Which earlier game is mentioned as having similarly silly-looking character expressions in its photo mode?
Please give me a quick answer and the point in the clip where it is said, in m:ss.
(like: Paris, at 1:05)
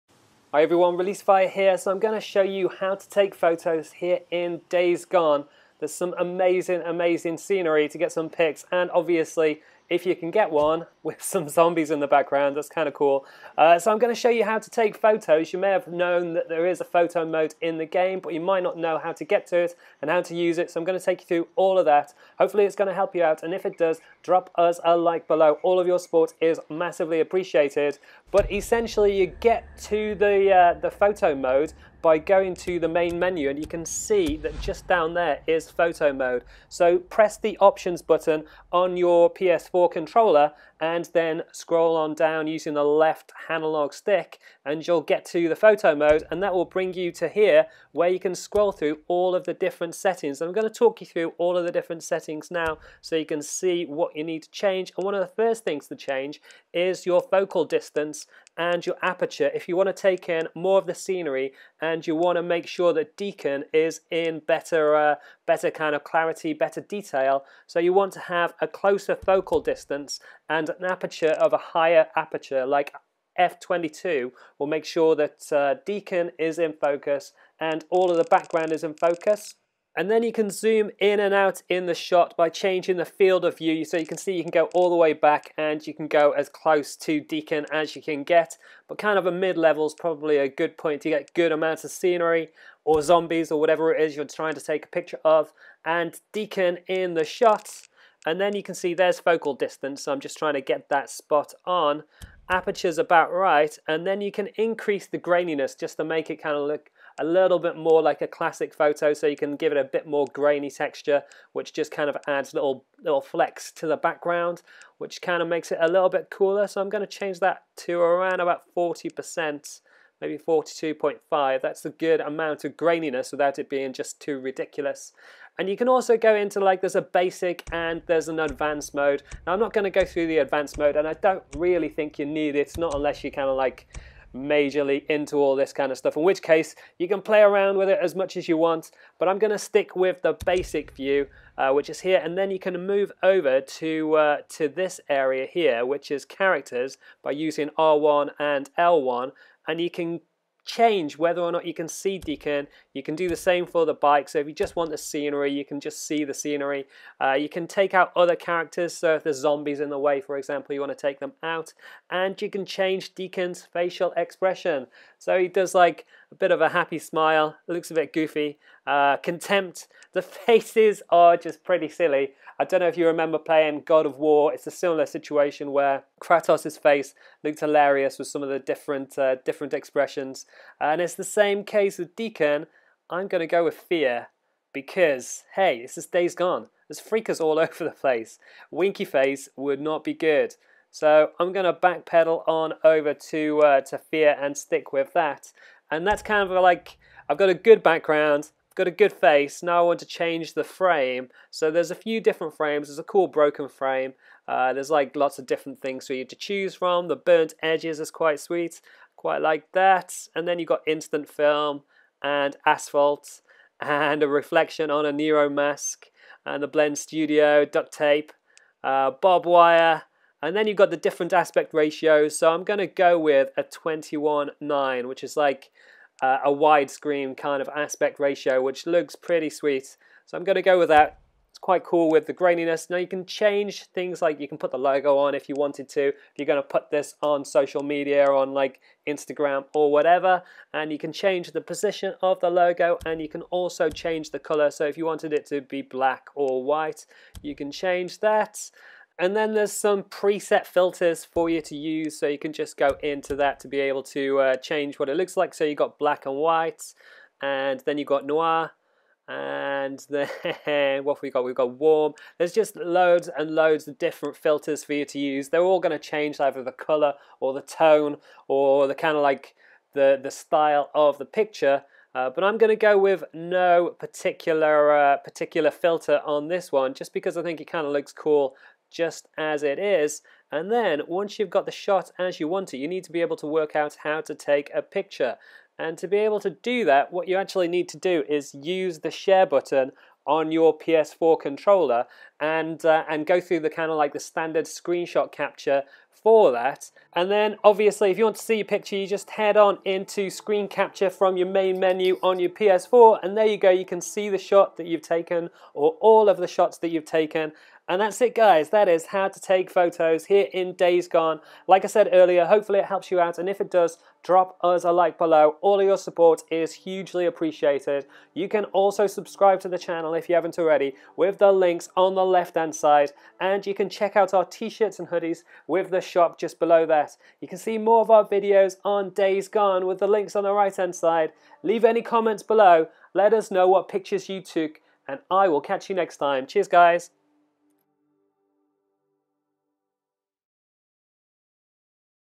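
God of War, at 2:53.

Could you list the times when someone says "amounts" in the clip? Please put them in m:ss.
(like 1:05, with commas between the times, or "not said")
1:31, 2:02.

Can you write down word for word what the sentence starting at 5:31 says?
Leave any comments below, let us know what pictures you took and I will catch you next time.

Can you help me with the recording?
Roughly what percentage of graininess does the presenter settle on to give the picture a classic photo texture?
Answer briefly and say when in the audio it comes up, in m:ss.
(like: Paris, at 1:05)
42.5%, at 2:00.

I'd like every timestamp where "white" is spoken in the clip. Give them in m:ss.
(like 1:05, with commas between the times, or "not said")
4:06, 4:16.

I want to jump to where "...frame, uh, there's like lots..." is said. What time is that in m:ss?
3:23.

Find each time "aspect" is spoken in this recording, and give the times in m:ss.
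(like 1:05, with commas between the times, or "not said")
3:41, 3:47.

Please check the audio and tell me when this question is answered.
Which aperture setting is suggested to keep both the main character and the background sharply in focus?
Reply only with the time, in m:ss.
1:13.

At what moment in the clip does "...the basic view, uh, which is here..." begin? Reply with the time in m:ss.
2:20.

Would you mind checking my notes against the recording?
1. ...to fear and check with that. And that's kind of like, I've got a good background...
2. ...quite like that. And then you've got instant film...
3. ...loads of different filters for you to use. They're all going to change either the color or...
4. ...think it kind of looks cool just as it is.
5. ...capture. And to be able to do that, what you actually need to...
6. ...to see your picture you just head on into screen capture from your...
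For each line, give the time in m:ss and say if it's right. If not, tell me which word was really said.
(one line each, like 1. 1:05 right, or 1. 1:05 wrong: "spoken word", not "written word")
1. 3:13 wrong: "stick", not "check"
2. 3:29 right
3. 4:23 right
4. 4:37 right
5. 4:44 wrong: "picture", not "capture"
6. 4:58 right.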